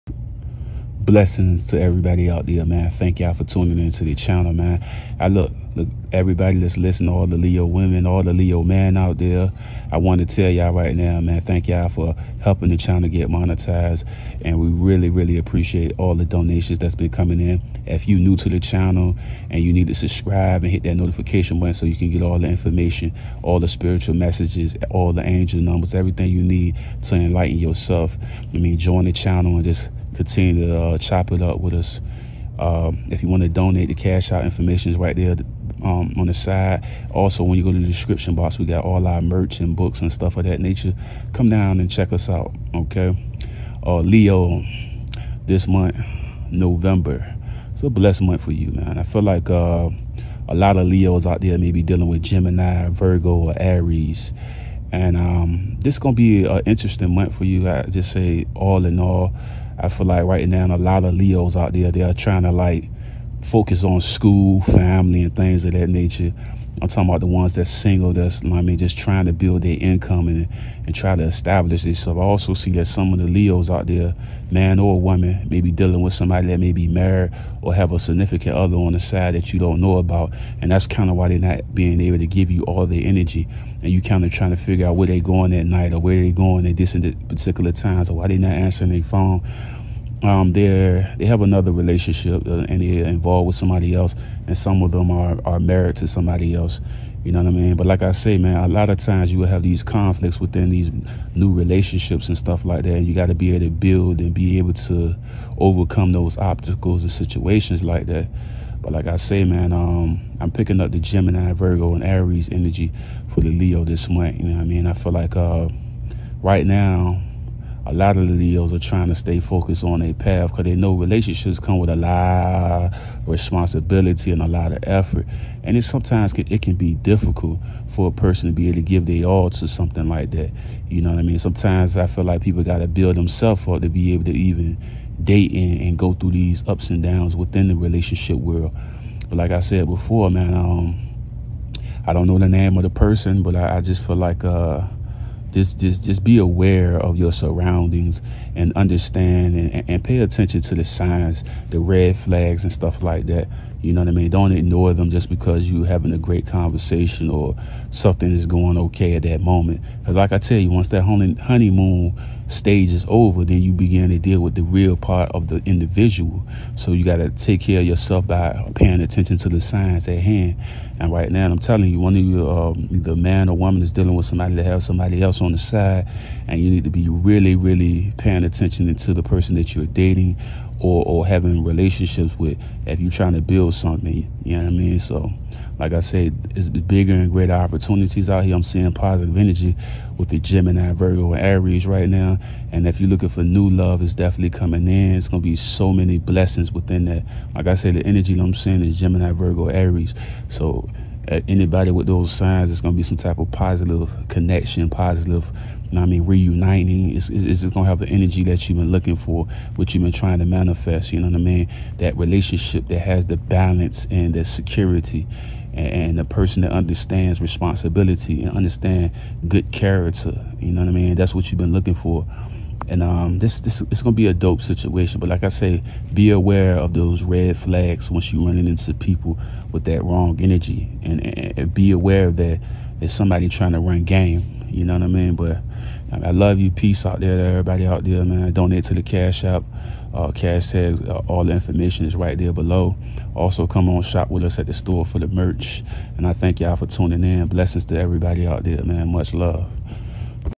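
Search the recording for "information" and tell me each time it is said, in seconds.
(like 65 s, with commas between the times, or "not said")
22 s, 34 s, 241 s.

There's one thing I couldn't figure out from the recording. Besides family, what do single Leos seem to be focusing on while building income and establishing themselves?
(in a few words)
School.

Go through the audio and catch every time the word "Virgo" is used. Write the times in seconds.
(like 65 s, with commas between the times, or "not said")
52 s, 111 s, 190 s, 199 s.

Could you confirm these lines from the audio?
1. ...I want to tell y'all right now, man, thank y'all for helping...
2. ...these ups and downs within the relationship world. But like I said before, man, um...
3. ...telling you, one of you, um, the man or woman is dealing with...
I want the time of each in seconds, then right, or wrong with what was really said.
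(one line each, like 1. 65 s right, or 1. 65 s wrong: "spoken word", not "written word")
1. 9 s right
2. 136 s right
3. 171 s right.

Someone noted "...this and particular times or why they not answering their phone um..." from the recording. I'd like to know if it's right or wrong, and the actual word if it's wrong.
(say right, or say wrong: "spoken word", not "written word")
right.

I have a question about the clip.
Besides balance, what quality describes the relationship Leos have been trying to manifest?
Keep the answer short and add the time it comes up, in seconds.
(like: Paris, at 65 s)
Security, at 214 s.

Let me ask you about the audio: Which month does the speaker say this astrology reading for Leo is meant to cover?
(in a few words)
November.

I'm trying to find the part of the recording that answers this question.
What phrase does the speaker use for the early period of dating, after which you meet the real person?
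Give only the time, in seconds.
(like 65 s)
161 s.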